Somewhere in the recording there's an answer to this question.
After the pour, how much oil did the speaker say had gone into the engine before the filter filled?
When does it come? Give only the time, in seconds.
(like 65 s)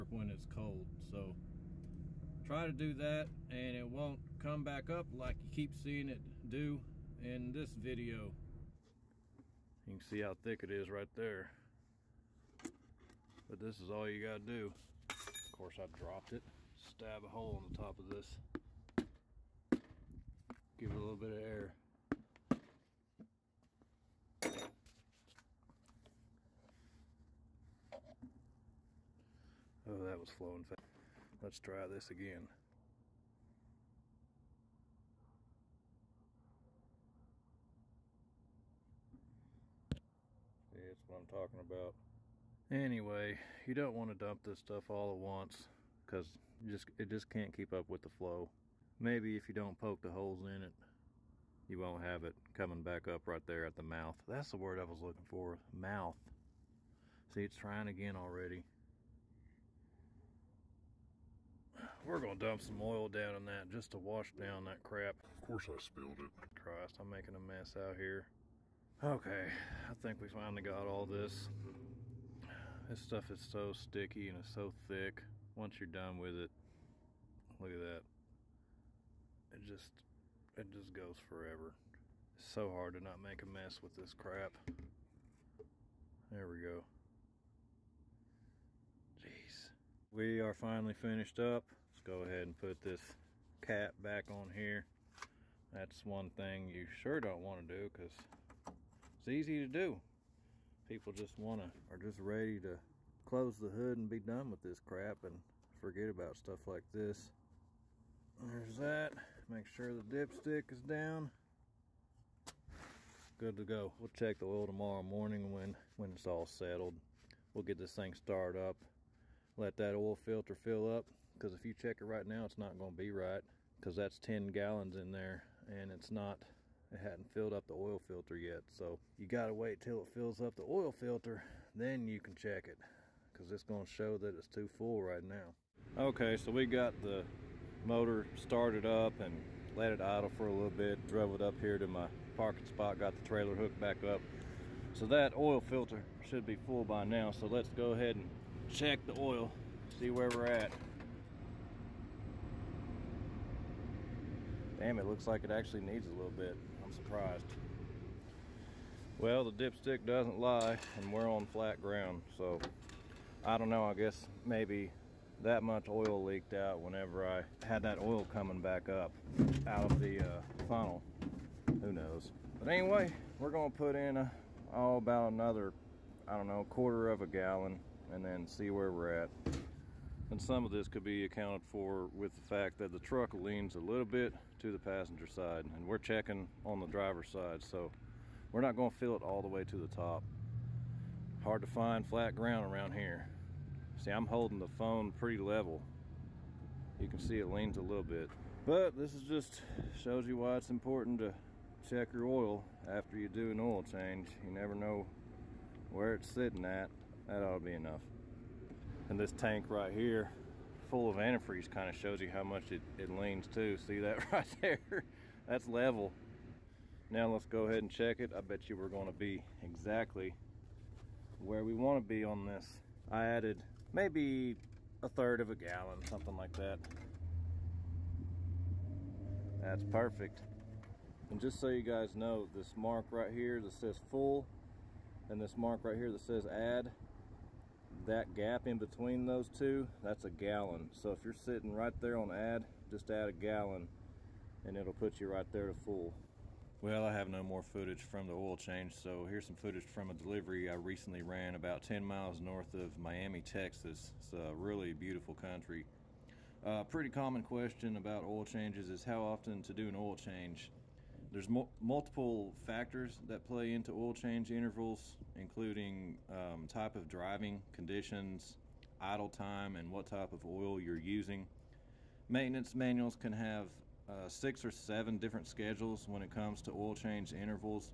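124 s.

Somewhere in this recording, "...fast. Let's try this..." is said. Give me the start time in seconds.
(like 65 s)
30 s.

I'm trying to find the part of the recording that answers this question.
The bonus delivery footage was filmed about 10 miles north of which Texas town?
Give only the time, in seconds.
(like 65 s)
252 s.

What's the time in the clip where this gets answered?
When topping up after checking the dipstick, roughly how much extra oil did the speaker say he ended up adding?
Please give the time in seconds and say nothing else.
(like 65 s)
225 s.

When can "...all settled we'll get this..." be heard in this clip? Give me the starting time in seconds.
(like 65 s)
116 s.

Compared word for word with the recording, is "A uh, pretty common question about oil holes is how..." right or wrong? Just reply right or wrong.
wrong.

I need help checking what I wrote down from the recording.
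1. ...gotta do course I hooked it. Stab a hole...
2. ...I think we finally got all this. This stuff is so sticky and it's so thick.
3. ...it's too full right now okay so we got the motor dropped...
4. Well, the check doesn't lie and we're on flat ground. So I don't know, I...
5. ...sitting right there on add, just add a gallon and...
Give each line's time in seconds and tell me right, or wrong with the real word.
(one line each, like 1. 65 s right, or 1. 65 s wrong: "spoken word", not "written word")
1. 14 s wrong: "dropped", not "hooked"
2. 69 s right
3. 134 s wrong: "started", not "dropped"
4. 159 s wrong: "dipstick", not "check"
5. 241 s right.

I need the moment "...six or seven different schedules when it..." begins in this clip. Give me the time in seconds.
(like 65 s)
274 s.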